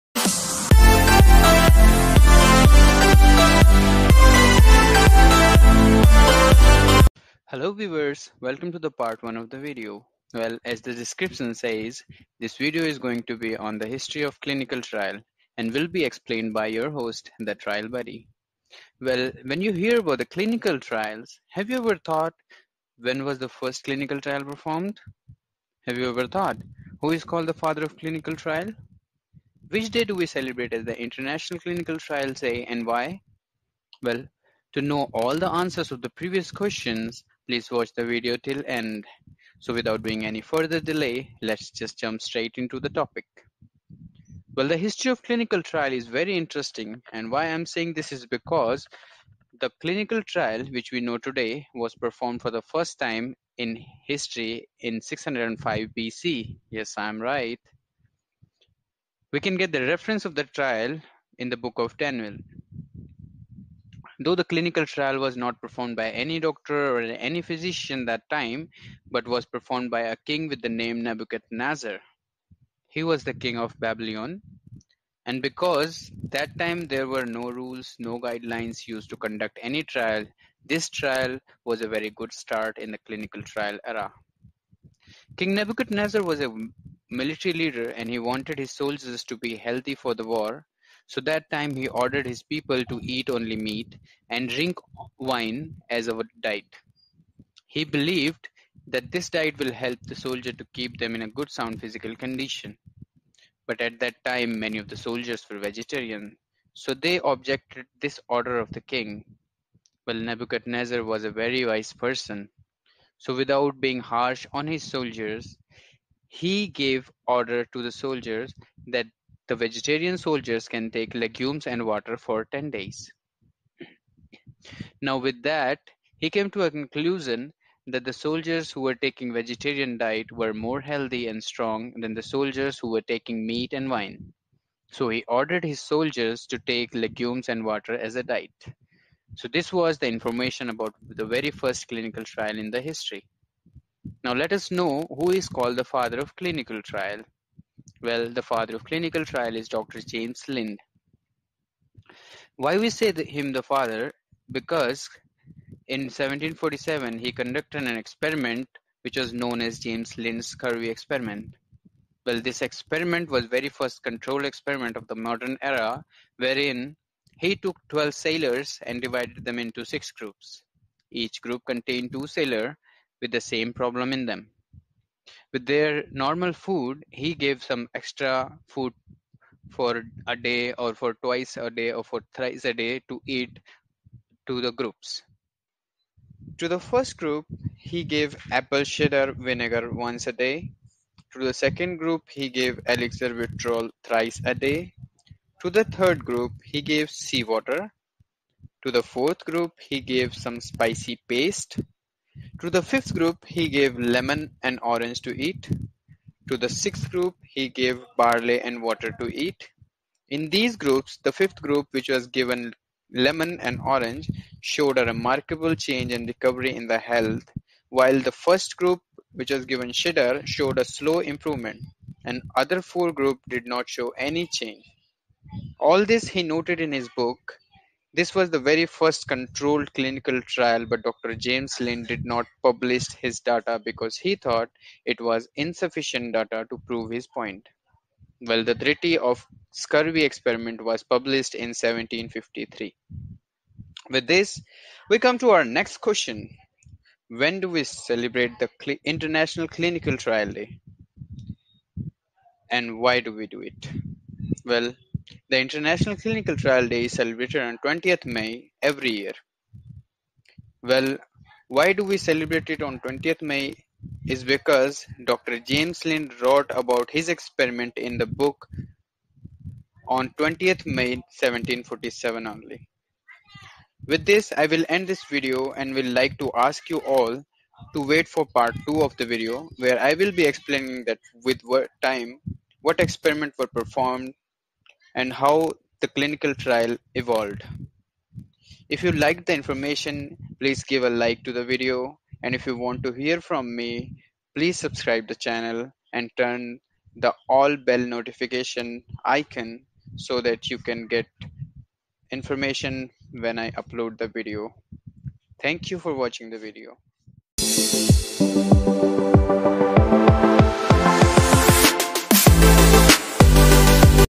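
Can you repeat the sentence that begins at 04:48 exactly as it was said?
If you like the information, please give a like to the video.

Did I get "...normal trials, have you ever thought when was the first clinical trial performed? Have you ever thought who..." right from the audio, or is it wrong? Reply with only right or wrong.
wrong.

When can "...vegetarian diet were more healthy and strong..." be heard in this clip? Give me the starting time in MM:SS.
02:09.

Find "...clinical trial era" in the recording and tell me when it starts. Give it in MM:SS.
01:22.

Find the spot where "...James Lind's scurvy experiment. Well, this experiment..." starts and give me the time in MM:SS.
02:39.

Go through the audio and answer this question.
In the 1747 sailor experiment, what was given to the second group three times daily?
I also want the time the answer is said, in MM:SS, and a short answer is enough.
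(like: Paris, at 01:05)
elixir vitriol, at 03:12.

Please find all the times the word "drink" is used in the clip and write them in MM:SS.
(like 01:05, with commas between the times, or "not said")
01:34.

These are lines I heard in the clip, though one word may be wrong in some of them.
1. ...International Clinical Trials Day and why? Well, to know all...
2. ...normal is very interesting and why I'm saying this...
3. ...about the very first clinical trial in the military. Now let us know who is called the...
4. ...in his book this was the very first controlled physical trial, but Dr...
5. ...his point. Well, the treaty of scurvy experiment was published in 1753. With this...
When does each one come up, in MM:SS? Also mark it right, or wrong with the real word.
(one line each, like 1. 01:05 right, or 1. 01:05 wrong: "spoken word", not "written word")
1. 00:30 right
2. 00:45 wrong: "trial", not "normal"
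3. 02:20 wrong: "history", not "military"
4. 03:46 wrong: "clinical", not "physical"
5. 03:57 right.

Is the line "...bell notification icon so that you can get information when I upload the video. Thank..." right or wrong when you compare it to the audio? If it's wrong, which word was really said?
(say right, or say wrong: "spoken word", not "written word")
right.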